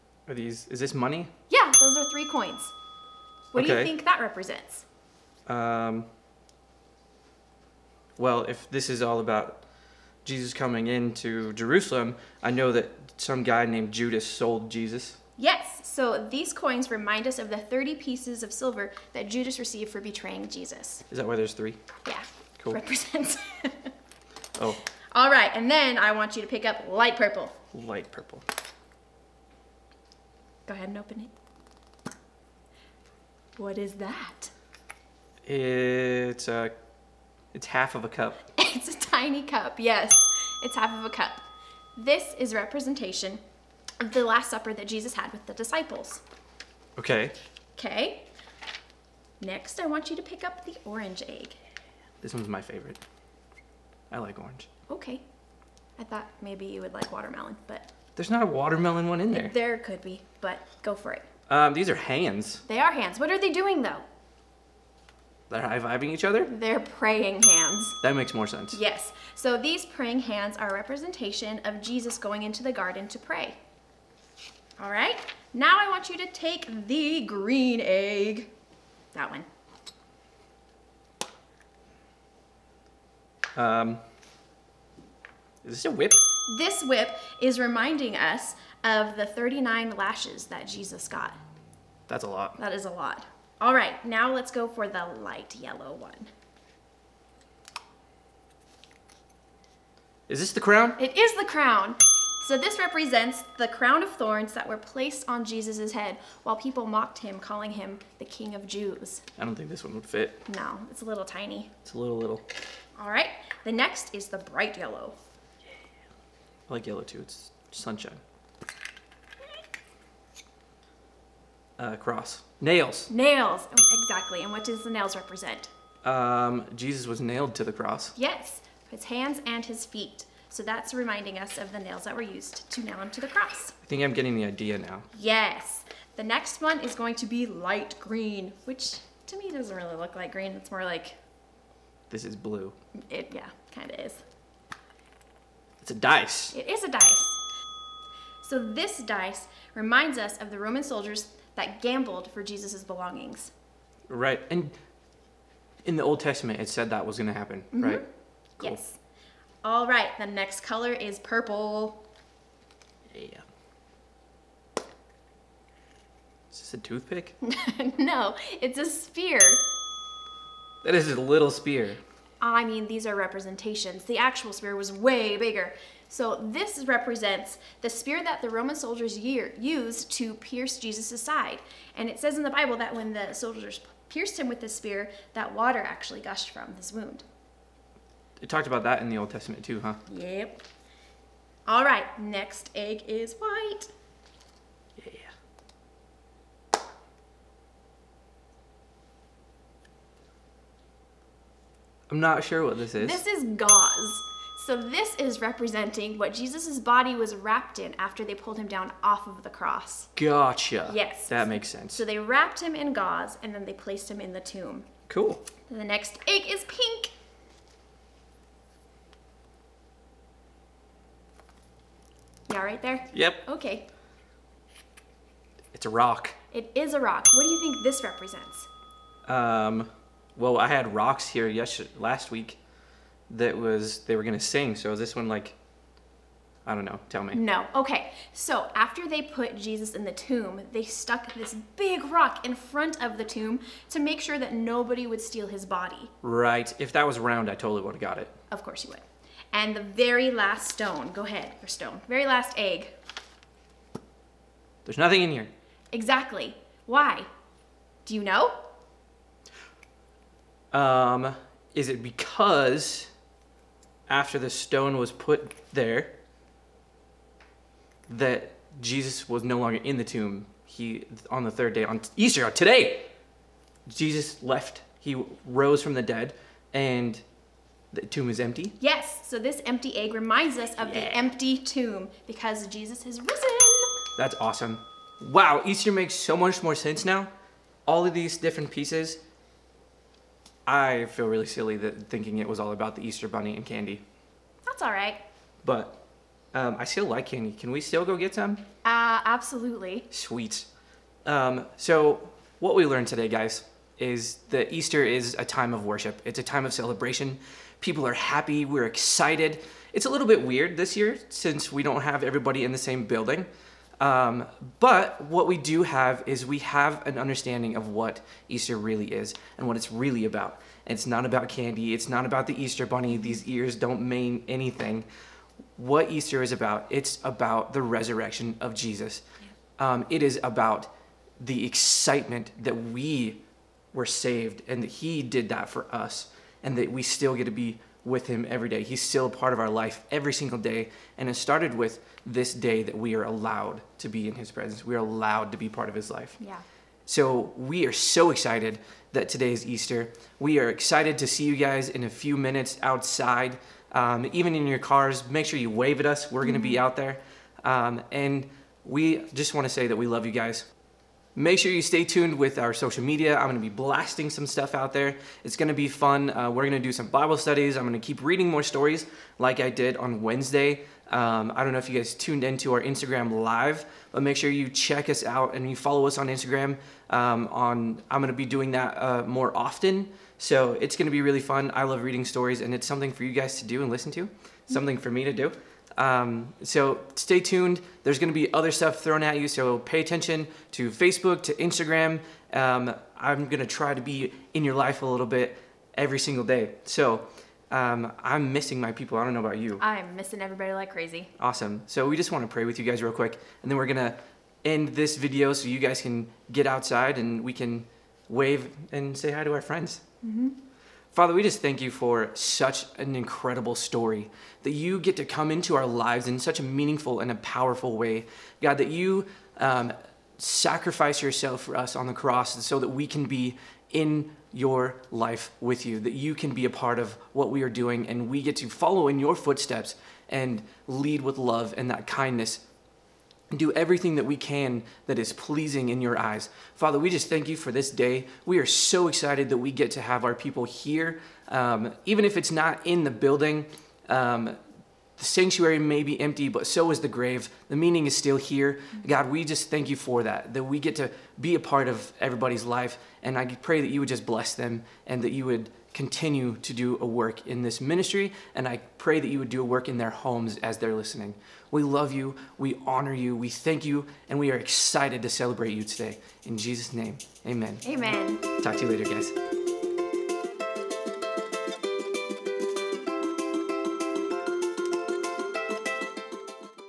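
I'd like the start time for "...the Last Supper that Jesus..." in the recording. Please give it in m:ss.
0:44.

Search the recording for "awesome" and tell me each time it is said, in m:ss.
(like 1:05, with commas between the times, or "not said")
4:44, 6:41.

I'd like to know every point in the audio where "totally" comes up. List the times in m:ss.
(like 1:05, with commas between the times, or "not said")
4:07.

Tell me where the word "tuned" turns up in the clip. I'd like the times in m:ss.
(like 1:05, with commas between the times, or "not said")
6:02, 6:12, 6:27.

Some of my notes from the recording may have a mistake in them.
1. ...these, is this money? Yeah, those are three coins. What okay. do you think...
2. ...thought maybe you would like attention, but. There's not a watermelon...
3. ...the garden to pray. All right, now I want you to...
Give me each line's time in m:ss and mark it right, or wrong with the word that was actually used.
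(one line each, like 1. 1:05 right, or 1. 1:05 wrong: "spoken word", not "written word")
1. 0:00 right
2. 0:56 wrong: "watermelon", not "attention"
3. 1:12 right.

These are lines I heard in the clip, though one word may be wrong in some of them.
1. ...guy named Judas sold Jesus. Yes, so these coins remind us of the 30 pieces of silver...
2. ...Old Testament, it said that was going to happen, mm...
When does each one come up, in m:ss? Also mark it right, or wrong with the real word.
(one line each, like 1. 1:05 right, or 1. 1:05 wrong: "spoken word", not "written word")
1. 0:13 right
2. 2:36 right.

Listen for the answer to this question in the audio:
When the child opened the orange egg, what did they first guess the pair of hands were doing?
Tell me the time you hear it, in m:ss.
1:05.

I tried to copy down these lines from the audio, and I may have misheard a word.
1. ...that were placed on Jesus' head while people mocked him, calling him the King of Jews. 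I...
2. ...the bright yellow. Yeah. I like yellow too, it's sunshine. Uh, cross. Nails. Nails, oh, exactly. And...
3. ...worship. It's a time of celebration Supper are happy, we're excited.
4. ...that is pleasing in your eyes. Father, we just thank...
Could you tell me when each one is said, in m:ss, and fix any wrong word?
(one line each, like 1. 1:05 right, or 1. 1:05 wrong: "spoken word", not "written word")
1. 1:44 right
2. 1:54 right
3. 5:05 wrong: "People", not "Supper"
4. 7:15 right.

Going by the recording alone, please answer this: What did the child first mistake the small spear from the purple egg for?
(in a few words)
A toothpick.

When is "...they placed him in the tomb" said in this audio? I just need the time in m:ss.
3:33.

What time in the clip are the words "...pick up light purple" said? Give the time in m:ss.
0:26.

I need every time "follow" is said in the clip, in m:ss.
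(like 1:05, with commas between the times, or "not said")
6:15, 7:08.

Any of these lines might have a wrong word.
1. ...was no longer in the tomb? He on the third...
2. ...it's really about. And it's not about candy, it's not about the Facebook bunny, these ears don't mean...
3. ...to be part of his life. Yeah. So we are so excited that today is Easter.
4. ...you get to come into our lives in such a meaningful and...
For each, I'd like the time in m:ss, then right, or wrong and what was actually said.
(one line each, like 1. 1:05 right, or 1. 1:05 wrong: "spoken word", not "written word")
1. 4:29 right
2. 5:19 wrong: "Easter", not "Facebook"
3. 5:45 right
4. 6:54 right.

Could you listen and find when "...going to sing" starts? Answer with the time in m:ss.
3:54.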